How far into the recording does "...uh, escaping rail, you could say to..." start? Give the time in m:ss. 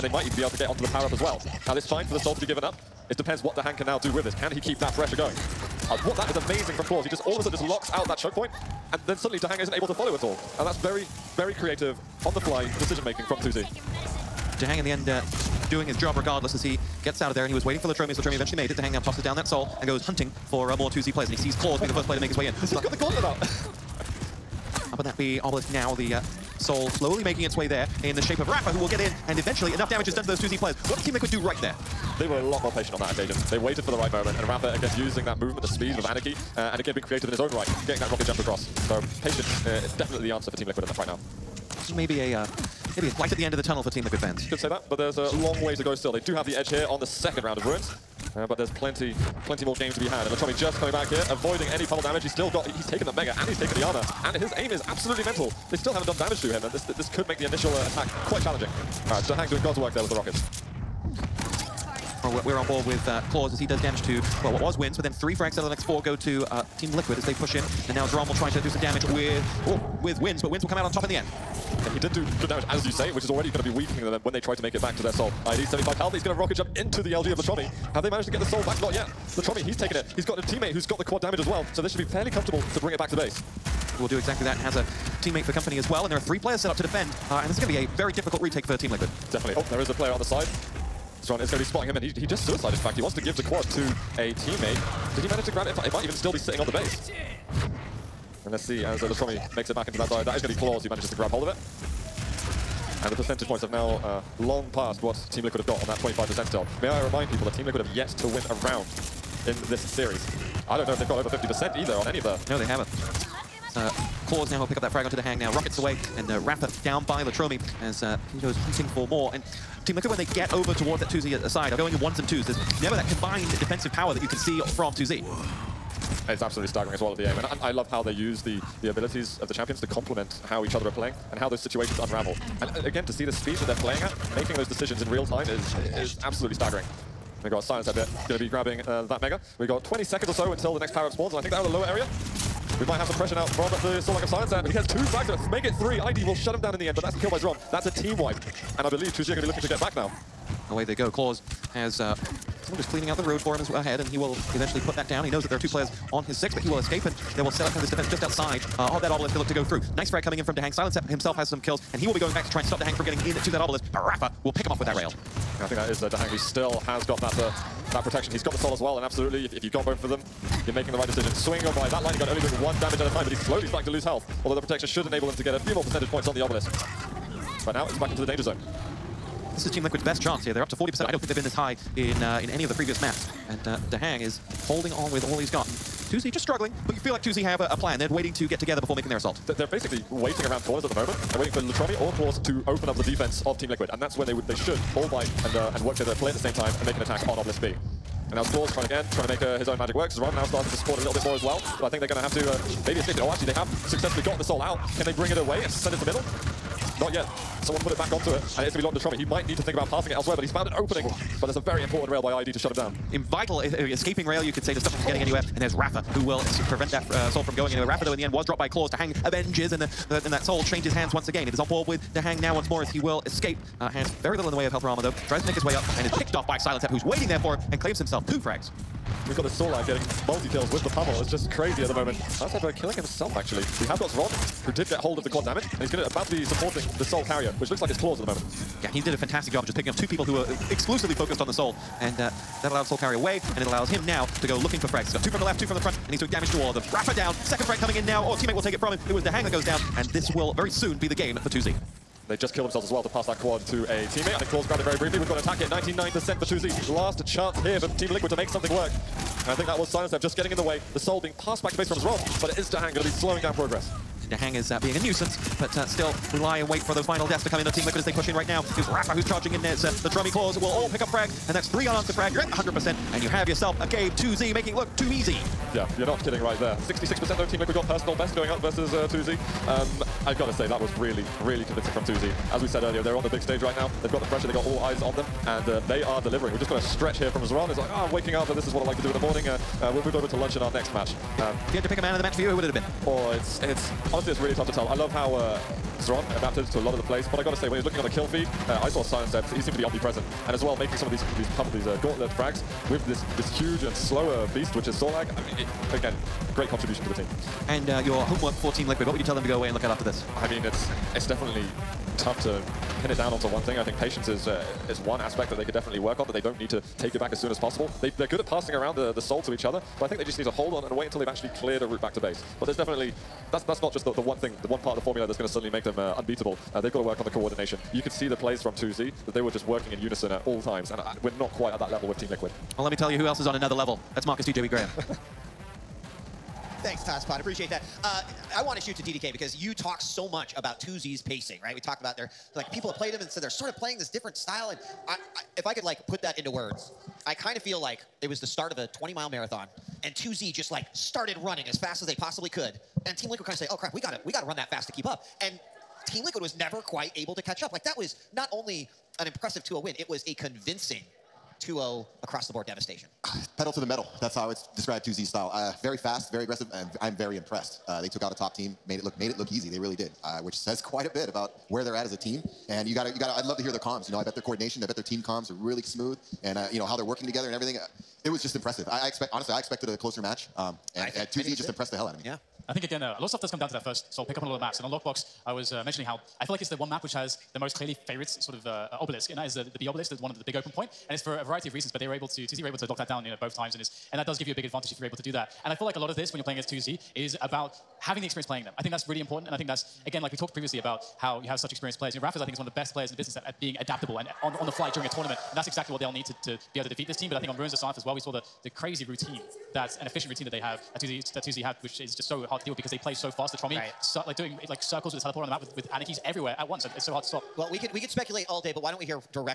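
3:33.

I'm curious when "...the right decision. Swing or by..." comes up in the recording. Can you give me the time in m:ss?
2:50.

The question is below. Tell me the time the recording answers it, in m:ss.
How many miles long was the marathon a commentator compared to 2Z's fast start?
5:48.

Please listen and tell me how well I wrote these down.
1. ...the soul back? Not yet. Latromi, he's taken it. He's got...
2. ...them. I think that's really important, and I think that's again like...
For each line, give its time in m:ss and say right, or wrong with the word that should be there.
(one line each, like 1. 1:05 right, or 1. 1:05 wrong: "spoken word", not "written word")
1. 1:18 right
2. 6:38 right.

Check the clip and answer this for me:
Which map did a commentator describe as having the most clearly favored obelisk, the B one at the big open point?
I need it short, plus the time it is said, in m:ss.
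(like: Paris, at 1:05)
Lockbox, at 6:24.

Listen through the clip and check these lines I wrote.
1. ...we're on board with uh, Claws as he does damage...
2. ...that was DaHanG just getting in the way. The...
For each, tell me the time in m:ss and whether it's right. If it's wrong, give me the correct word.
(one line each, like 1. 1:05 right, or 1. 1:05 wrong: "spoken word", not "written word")
1. 1:02 right
2. 4:19 wrong: "Silencep", not "DaHanG".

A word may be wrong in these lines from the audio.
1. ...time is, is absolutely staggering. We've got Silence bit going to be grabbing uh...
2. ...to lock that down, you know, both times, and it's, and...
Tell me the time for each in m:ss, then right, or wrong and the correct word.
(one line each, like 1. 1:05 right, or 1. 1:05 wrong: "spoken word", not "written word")
1. 2:15 right
2. 6:32 right.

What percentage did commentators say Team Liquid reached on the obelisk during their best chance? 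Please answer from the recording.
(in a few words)
40%.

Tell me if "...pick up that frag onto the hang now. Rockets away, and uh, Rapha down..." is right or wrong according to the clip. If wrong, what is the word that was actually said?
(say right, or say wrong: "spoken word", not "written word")
right.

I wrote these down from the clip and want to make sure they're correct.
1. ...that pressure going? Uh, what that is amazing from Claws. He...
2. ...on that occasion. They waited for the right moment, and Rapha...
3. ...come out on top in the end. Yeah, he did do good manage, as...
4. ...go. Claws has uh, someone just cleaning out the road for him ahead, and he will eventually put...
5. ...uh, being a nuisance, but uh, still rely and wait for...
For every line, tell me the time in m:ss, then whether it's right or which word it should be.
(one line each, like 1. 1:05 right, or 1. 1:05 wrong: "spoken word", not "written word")
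1. 0:04 right
2. 0:32 right
3. 1:10 wrong: "damage", not "manage"
4. 2:30 right
5. 4:24 right.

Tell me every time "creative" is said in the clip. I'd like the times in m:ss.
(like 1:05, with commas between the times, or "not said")
0:11, 0:37.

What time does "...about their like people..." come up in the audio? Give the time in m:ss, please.
5:42.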